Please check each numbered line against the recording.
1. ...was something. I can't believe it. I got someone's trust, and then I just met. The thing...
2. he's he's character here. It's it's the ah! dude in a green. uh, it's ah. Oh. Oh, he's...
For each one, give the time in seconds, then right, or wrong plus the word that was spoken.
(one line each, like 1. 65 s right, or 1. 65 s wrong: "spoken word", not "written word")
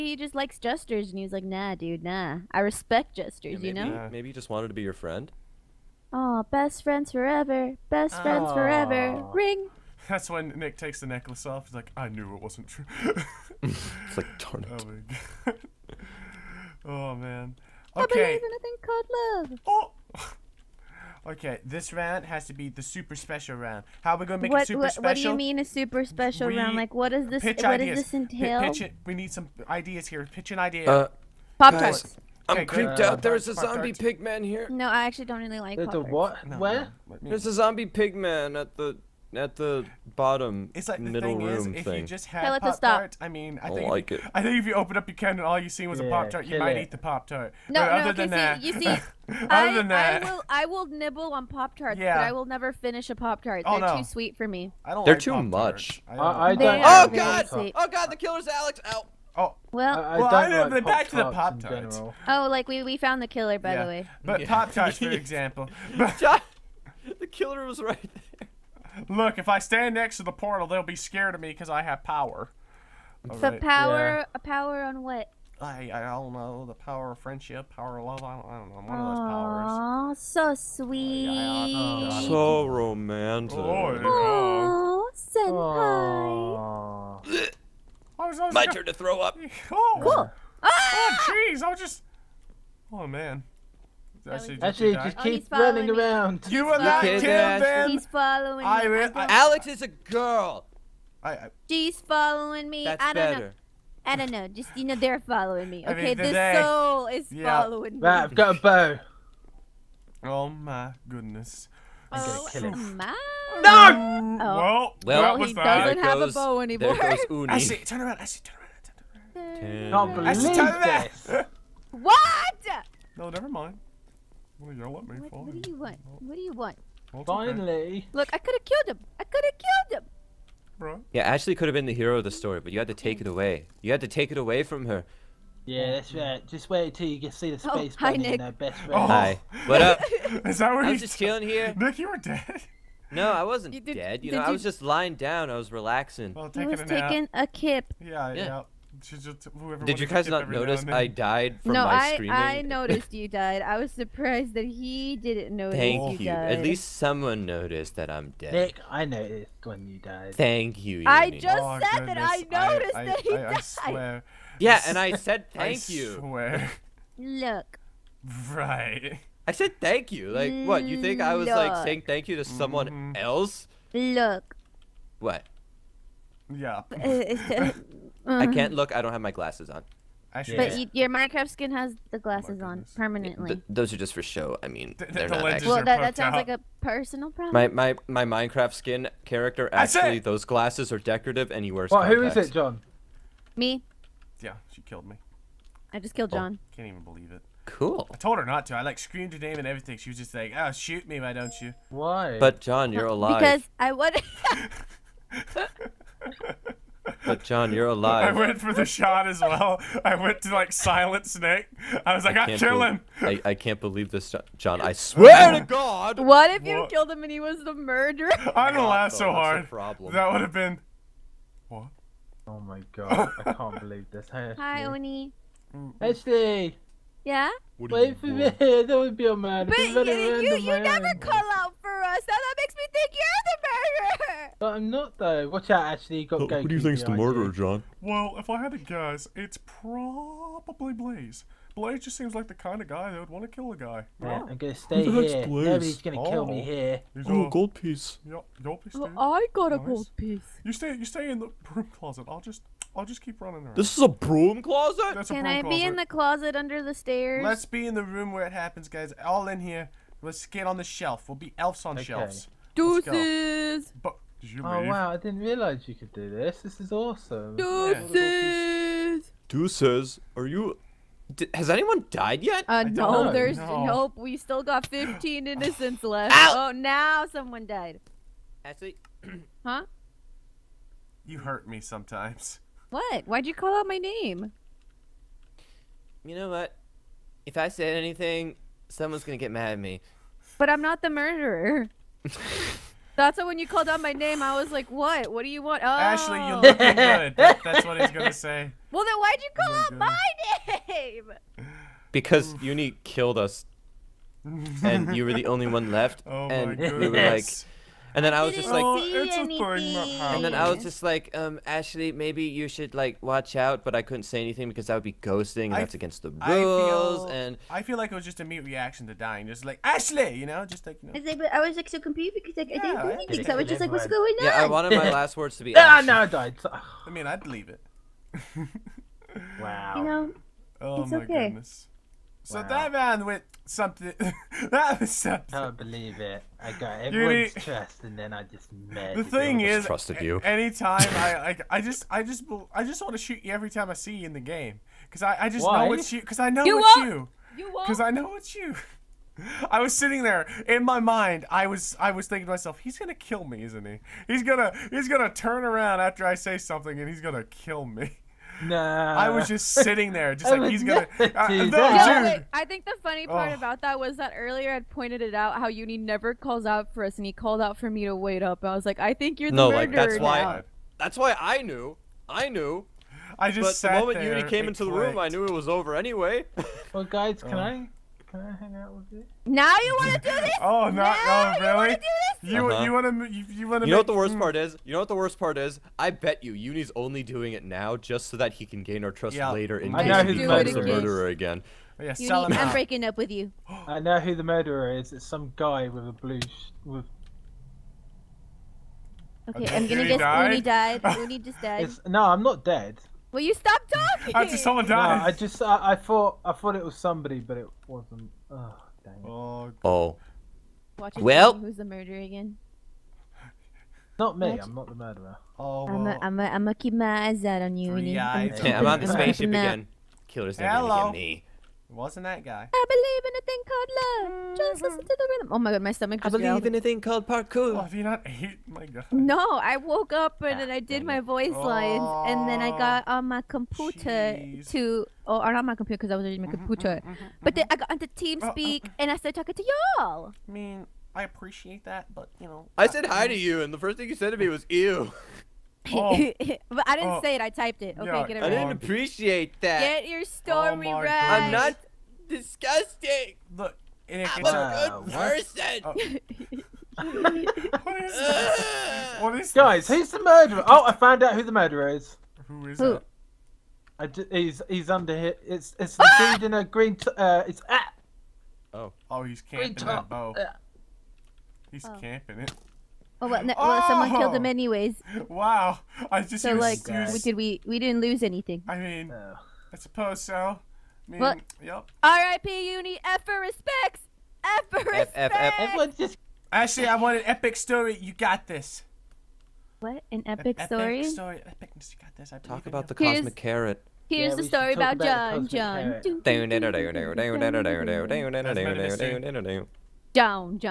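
1. 335 s wrong: "everyone", not "someone"
2. 464 s wrong: "under", not "character".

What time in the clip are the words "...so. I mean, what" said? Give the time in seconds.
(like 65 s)
480 s.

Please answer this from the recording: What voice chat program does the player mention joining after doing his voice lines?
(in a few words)
TeamSpeak.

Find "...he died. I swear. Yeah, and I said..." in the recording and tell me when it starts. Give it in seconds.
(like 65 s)
163 s.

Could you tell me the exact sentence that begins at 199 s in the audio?
She was just like, "Oh, shoot me, why don't you?" Why?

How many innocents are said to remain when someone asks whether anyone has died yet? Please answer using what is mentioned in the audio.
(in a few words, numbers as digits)
15.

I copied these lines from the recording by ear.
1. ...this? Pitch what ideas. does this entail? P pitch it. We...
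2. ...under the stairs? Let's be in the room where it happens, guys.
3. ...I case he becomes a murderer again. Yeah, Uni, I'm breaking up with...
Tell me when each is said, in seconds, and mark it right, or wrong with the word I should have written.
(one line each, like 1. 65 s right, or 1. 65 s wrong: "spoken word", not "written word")
1. 27 s right
2. 256 s right
3. 389 s right.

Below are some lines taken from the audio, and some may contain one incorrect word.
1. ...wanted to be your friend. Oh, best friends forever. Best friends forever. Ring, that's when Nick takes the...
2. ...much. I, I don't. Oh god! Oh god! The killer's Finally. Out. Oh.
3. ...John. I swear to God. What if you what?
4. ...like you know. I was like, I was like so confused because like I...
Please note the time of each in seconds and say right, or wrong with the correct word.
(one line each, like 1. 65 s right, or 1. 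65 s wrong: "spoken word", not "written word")
1. 4 s right
2. 55 s wrong: "Alex", not "Finally"
3. 214 s right
4. 320 s right.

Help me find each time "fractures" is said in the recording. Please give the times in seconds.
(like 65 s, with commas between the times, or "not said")
not said.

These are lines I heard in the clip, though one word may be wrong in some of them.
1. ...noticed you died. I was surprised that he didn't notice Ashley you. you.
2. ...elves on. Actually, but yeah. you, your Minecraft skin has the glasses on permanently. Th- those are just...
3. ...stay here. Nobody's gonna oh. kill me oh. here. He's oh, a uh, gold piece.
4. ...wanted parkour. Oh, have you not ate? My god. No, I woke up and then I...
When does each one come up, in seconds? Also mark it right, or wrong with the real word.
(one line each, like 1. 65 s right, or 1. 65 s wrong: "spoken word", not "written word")
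1. 152 s wrong: "Thank", not "Ashley"
2. 179 s wrong: "glasses", not "elves"
3. 244 s right
4. 426 s wrong: "called", not "wanted".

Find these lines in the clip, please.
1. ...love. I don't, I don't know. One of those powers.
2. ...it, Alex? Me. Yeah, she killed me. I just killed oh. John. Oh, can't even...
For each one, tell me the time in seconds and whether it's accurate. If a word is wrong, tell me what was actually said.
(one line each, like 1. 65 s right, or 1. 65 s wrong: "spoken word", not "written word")
1. 78 s right
2. 192 s wrong: "John", not "Alex".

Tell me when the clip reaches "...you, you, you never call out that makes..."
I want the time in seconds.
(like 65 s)
229 s.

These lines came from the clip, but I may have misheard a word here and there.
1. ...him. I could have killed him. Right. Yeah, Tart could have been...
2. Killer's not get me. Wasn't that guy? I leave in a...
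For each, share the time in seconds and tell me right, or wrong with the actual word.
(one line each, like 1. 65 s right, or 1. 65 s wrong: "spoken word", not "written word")
1. 128 s wrong: "Ashley", not "Tart"
2. 420 s wrong: "believe", not "leave".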